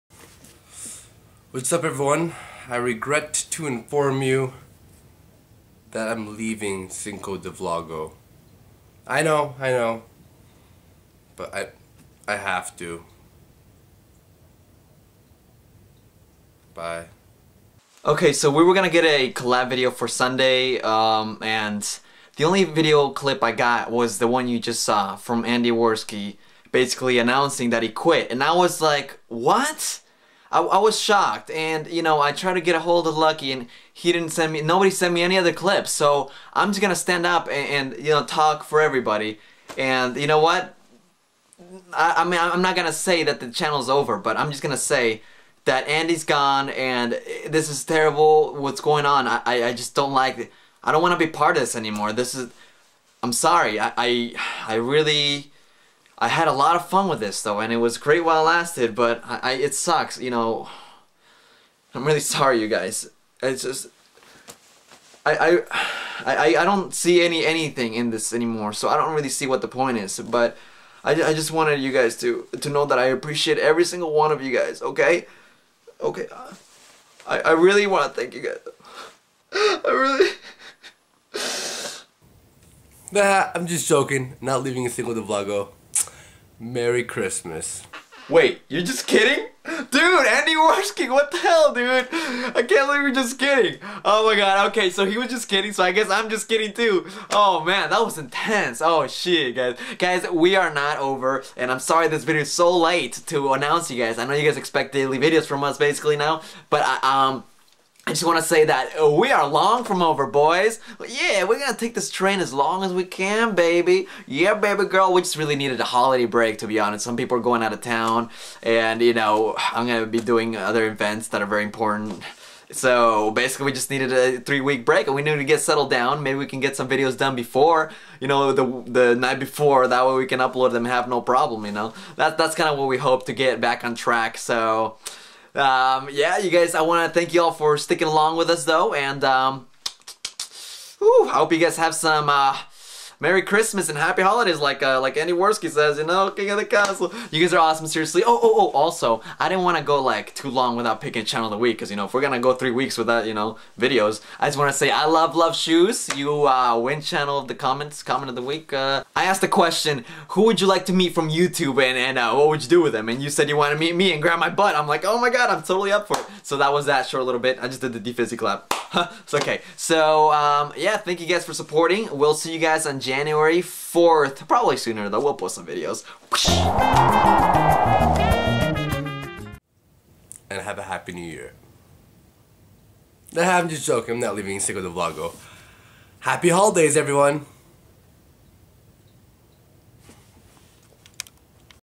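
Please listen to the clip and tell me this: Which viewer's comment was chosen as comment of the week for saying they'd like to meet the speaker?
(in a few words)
Love Shoes.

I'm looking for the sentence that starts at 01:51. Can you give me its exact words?
Yeah, we're going to take this train as long as we can, baby.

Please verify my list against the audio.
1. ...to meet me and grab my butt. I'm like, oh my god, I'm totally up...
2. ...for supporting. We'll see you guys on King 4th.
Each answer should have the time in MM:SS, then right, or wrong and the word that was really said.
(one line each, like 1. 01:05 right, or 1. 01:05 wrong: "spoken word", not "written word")
1. 02:43 right
2. 02:51 wrong: "January", not "King".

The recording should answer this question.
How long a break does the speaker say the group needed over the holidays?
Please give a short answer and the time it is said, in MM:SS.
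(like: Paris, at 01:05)
3 weeks, at 02:04.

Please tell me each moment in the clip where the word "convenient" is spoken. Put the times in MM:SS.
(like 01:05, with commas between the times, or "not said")
not said.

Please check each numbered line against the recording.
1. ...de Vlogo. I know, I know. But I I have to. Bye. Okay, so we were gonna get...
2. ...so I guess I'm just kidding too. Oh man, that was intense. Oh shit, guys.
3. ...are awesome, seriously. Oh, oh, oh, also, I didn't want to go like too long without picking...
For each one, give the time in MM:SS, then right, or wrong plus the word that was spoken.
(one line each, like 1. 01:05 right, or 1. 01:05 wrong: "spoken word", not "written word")
1. 00:07 right
2. 01:35 right
3. 02:27 right.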